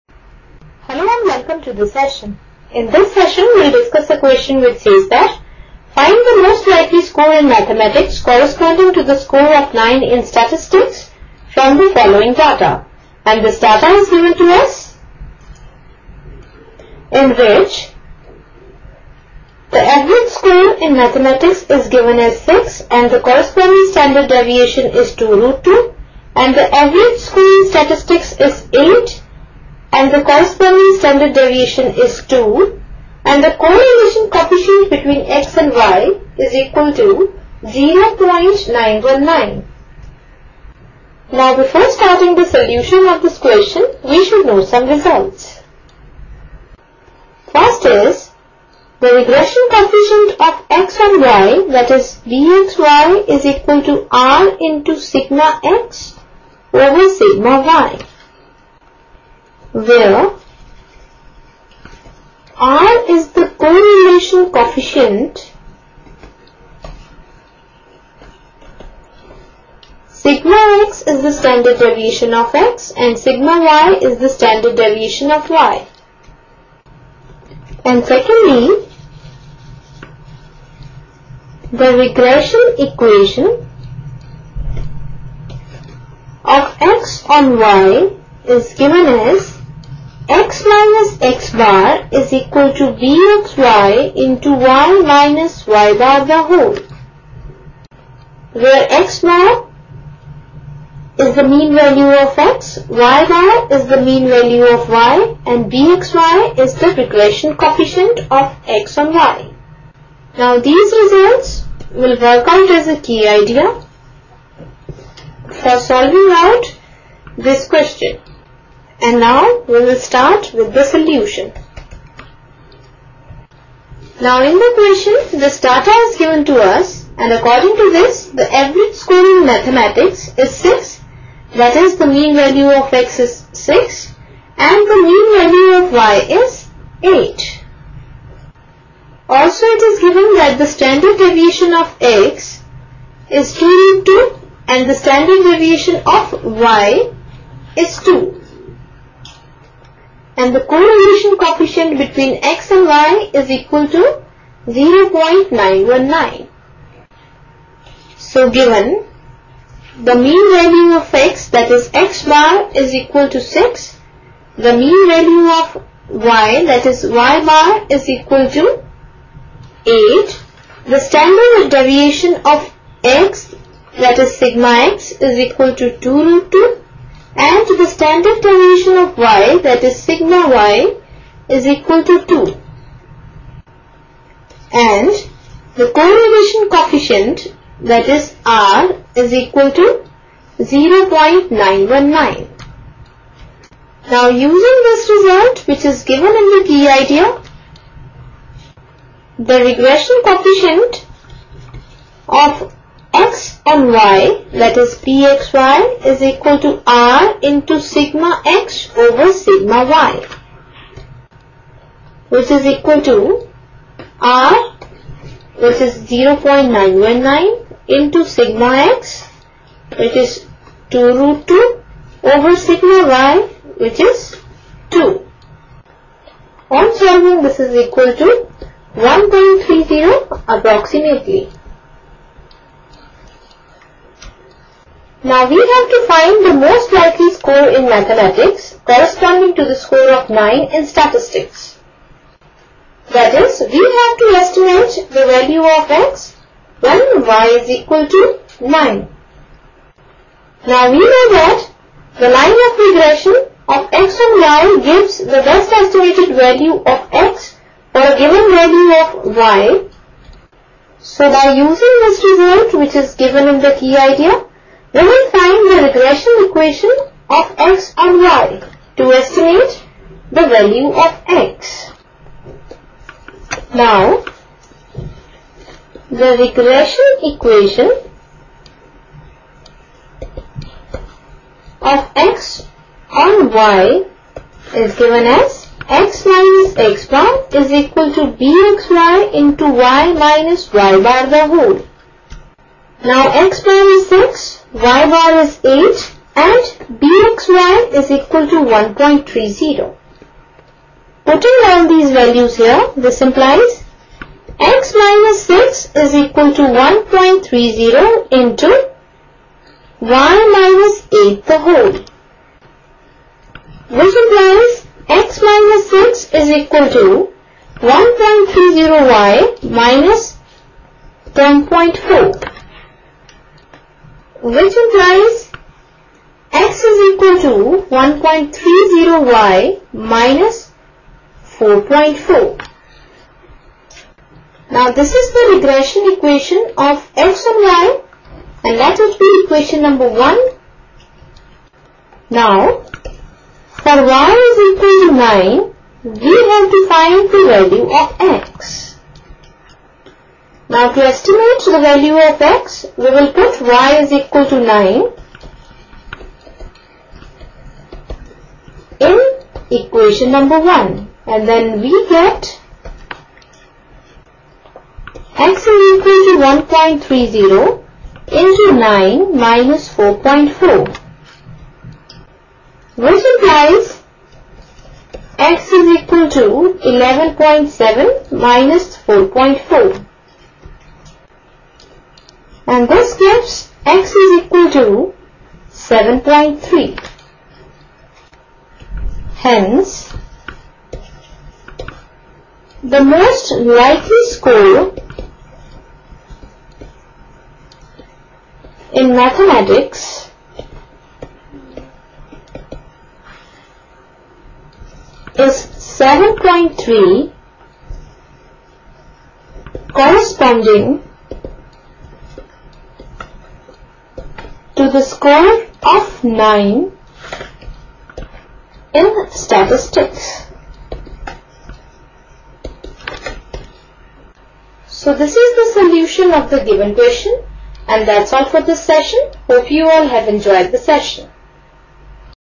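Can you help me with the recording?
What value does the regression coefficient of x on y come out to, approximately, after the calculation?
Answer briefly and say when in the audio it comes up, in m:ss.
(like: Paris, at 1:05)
1.30, at 3:48.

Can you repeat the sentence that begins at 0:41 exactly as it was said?
Now before starting the solution of this question, we should know some results.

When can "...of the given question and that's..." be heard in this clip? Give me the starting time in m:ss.
7:06.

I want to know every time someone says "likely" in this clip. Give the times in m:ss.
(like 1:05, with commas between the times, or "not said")
0:06, 3:56, 6:33.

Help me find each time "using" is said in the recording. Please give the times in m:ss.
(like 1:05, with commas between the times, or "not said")
3:14, 4:21.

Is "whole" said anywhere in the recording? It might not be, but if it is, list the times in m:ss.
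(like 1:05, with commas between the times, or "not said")
1:36, 4:51, 5:11.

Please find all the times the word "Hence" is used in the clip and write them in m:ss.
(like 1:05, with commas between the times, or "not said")
6:29.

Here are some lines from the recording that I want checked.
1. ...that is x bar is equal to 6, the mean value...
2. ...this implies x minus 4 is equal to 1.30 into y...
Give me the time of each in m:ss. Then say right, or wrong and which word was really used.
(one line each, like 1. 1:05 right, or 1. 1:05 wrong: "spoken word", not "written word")
1. 2:41 right
2. 5:02 wrong: "6", not "4".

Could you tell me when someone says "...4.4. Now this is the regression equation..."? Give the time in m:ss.
5:31.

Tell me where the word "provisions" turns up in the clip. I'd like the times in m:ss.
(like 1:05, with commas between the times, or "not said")
not said.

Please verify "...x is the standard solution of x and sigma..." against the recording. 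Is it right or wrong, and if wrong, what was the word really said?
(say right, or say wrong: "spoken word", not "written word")
wrong: "deviation", not "solution".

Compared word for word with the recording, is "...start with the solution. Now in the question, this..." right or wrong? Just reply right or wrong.
right.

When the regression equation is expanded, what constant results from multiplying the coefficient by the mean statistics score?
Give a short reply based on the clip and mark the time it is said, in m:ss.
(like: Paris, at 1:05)
10.4, at 5:21.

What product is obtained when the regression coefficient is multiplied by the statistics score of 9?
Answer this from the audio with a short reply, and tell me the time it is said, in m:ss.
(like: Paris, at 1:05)
11.7, at 6:16.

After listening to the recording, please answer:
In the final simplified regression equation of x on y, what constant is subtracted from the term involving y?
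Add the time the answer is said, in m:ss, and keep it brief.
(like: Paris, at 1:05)
4.4, at 5:26.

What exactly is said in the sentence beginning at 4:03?
That is, we have to estimate the value of x when y is equal to 9.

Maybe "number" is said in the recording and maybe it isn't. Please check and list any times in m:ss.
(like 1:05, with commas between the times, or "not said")
5:39, 6:00.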